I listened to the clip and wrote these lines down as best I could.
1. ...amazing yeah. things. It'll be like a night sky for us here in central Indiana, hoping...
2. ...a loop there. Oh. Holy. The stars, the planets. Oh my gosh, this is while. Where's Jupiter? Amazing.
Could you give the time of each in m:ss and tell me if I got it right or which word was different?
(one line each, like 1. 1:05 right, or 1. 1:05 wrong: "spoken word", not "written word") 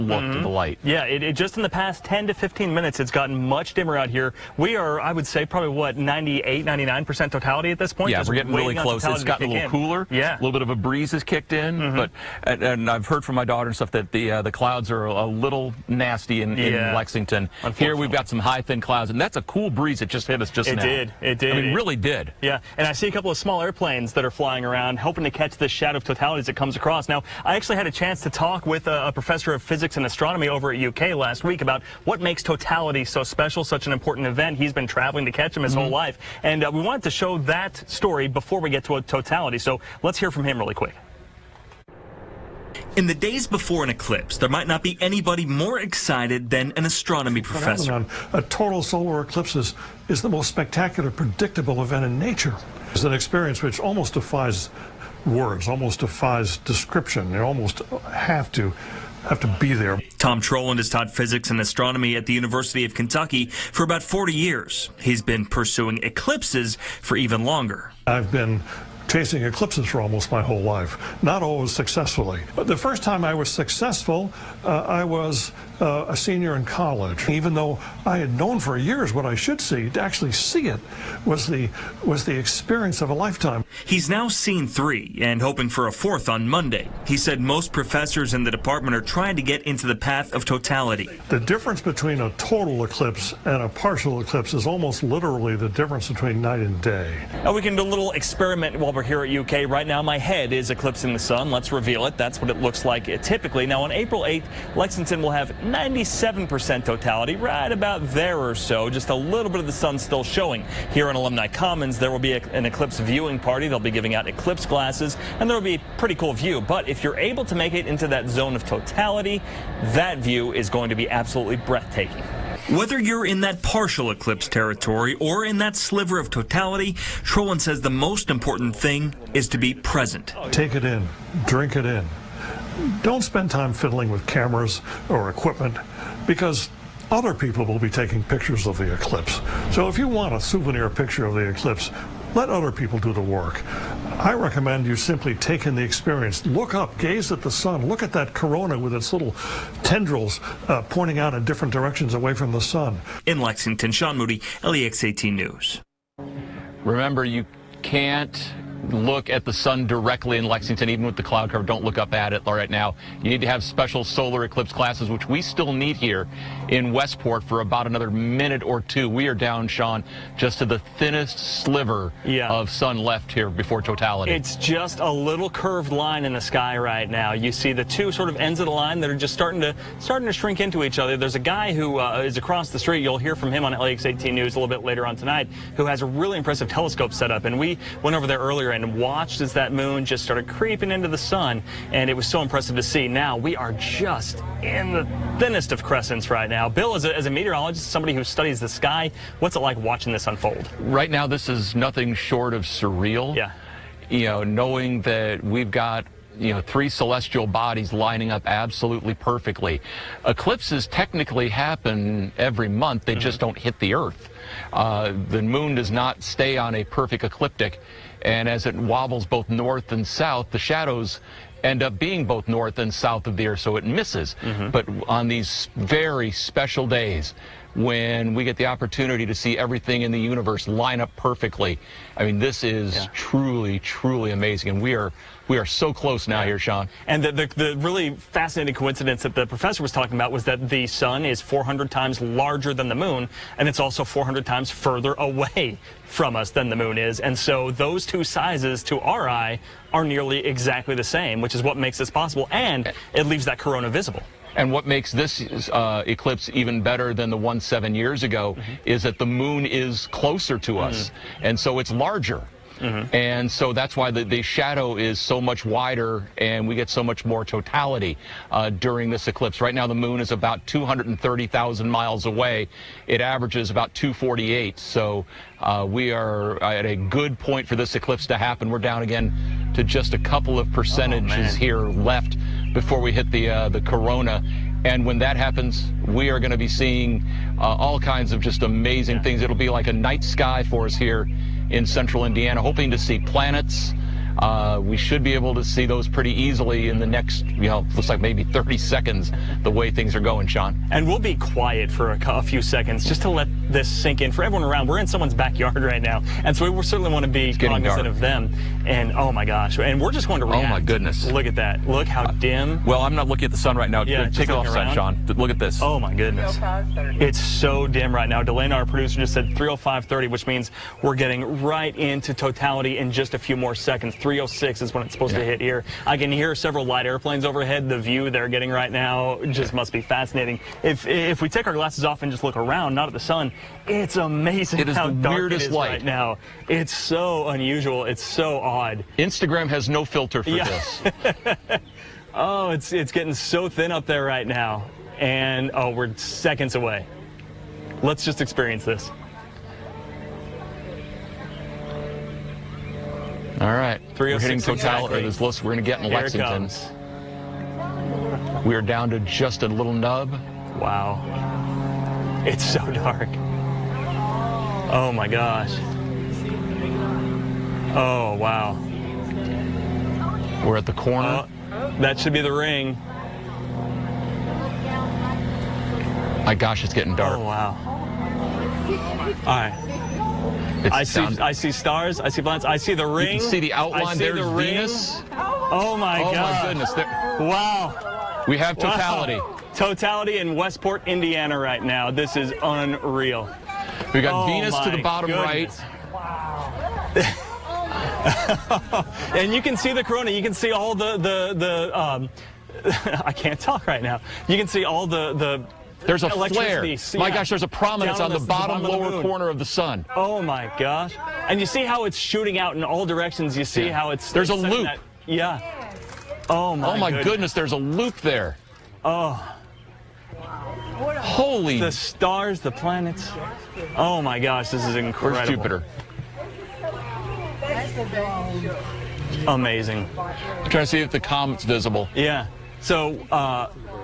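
1. 4:48 right
2. 6:57 wrong: "incredible", not "while".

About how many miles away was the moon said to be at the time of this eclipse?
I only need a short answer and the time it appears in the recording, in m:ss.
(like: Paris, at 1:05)
230,000 miles, at 4:30.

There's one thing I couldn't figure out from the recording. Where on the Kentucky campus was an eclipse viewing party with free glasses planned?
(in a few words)
Alumni Commons.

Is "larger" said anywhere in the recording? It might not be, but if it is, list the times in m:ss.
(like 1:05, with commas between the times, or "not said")
4:02, 4:21.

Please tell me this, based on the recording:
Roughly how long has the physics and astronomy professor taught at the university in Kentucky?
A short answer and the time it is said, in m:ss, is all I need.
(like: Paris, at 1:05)
40 years, at 1:03.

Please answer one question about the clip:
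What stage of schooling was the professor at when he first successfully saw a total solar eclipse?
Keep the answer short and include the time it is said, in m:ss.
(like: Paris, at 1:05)
Senior in college, at 1:16.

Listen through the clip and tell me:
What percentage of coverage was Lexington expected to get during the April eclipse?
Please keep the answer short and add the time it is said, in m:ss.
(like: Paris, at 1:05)
97%, at 1:45.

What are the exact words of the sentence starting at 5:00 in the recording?
And we'll be quiet for a, a few seconds just to let this sink in.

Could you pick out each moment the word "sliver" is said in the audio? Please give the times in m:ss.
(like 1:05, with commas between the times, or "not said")
2:05, 2:51.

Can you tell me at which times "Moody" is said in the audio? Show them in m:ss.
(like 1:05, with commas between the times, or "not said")
2:34.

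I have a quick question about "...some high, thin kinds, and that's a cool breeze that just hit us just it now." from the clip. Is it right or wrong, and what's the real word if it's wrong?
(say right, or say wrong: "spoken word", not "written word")
wrong: "clouds", not "kinds".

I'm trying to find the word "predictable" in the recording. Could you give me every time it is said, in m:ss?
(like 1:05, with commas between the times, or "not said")
0:51.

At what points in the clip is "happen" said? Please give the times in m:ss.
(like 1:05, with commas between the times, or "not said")
3:31, 4:38, 4:45.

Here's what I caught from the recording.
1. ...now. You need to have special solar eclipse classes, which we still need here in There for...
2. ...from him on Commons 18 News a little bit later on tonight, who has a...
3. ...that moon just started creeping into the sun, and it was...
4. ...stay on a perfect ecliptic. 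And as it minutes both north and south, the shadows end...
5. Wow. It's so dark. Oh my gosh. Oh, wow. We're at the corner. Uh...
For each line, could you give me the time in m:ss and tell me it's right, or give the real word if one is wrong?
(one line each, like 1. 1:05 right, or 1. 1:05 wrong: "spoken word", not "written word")
1. 2:42 wrong: "Westport", not "There"
2. 3:03 wrong: "LEX", not "Commons"
3. 3:09 right
4. 3:36 wrong: "wobbles", not "minutes"
5. 6:00 right.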